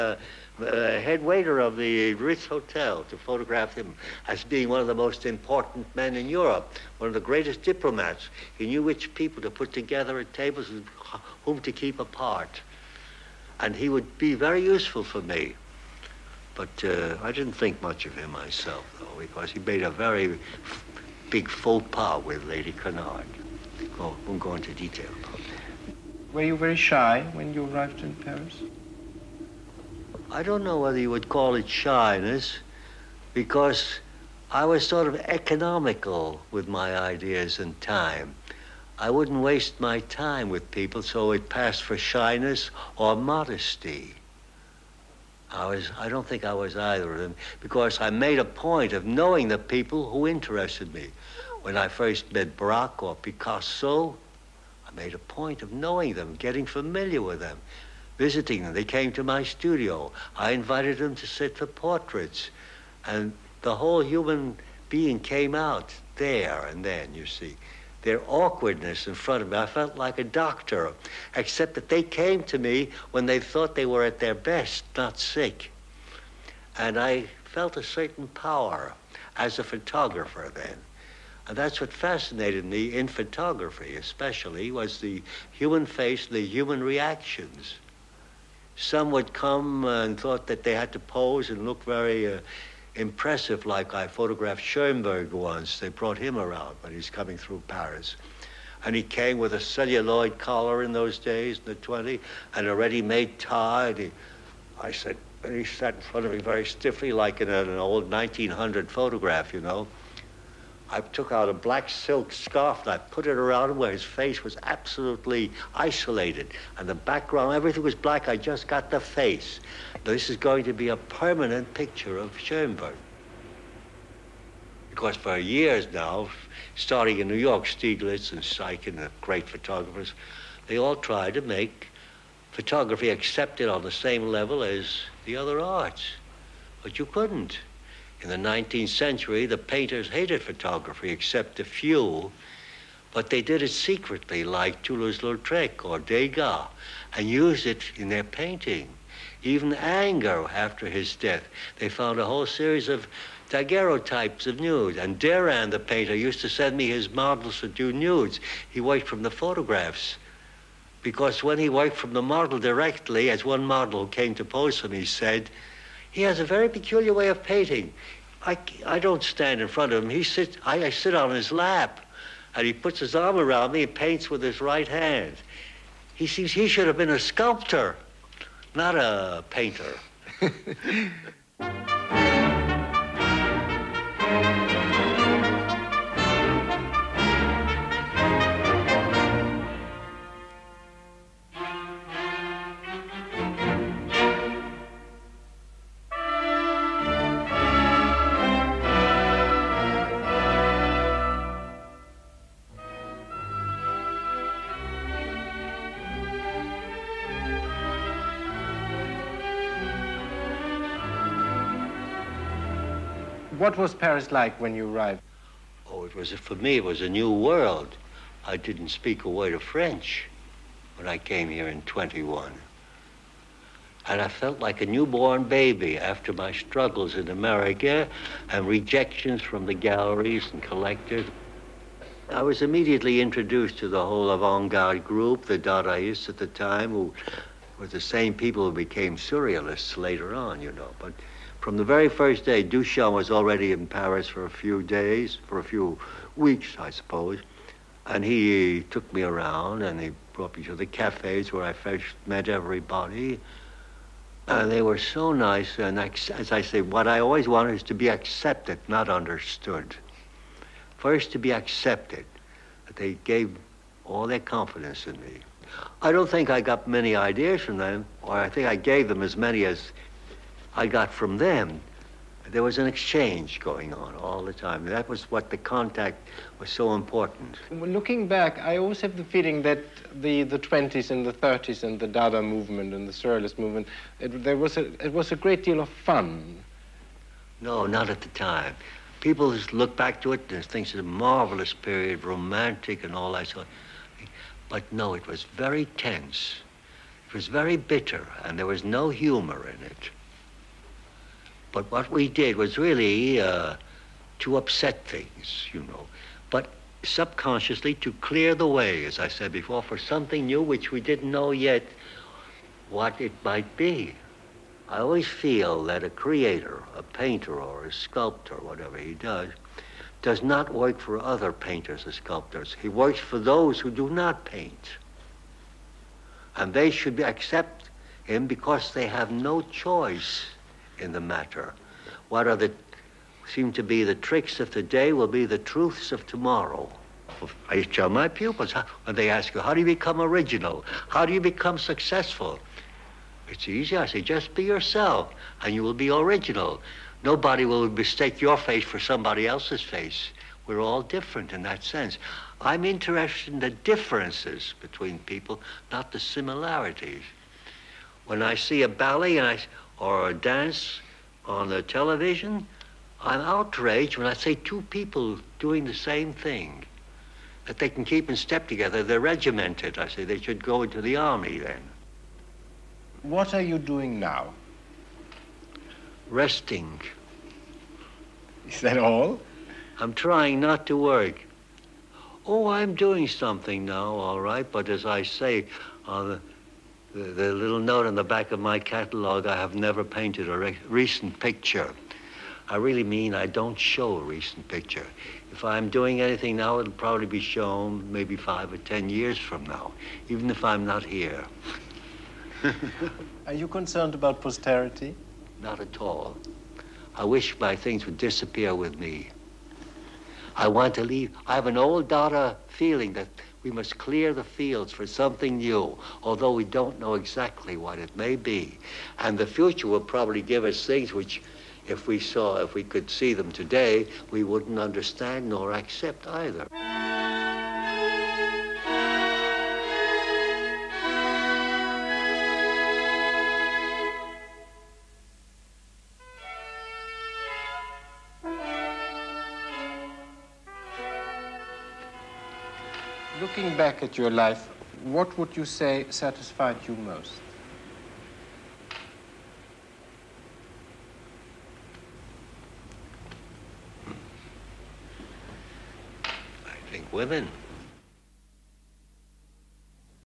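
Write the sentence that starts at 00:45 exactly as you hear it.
I was I don't think I was either of them because I made a point of knowing the people who interested me.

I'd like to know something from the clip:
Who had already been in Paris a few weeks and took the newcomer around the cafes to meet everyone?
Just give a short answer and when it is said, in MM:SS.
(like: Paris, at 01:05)
Duchamp, at 04:02.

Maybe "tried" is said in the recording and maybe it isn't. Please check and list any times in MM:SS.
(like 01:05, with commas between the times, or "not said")
02:10.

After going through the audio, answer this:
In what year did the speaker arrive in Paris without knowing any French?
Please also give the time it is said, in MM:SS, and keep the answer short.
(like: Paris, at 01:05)
1921, at 03:41.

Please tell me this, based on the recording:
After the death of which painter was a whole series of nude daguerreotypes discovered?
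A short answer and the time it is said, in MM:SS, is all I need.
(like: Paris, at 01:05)
Ingres, at 02:29.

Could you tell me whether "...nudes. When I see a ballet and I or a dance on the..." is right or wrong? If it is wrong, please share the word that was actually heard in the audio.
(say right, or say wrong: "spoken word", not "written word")
wrong: "similarities", not "nudes".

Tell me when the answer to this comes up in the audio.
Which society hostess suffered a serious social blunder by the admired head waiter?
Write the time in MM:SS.
00:22.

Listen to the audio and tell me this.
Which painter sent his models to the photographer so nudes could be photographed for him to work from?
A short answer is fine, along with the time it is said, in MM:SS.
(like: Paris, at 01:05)
Duran, at 02:35.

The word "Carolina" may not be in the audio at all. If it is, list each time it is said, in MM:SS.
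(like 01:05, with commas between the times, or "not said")
not said.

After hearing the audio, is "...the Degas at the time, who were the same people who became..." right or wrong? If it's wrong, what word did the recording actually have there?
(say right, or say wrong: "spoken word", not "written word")
wrong: "Dadaists", not "Degas".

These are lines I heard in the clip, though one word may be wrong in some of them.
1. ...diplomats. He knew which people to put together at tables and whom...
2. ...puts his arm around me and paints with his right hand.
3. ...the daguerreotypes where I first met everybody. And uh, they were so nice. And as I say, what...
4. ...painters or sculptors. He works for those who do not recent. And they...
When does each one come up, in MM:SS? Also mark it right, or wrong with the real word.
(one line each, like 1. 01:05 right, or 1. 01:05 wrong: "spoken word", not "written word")
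1. 00:07 right
2. 02:52 right
3. 04:10 wrong: "cafes", not "daguerreotypes"
4. 05:21 wrong: "paint", not "recent".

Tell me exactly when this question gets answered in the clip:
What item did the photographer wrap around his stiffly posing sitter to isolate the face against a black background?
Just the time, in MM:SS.
01:51.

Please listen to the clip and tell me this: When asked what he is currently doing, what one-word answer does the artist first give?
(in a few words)
Resting.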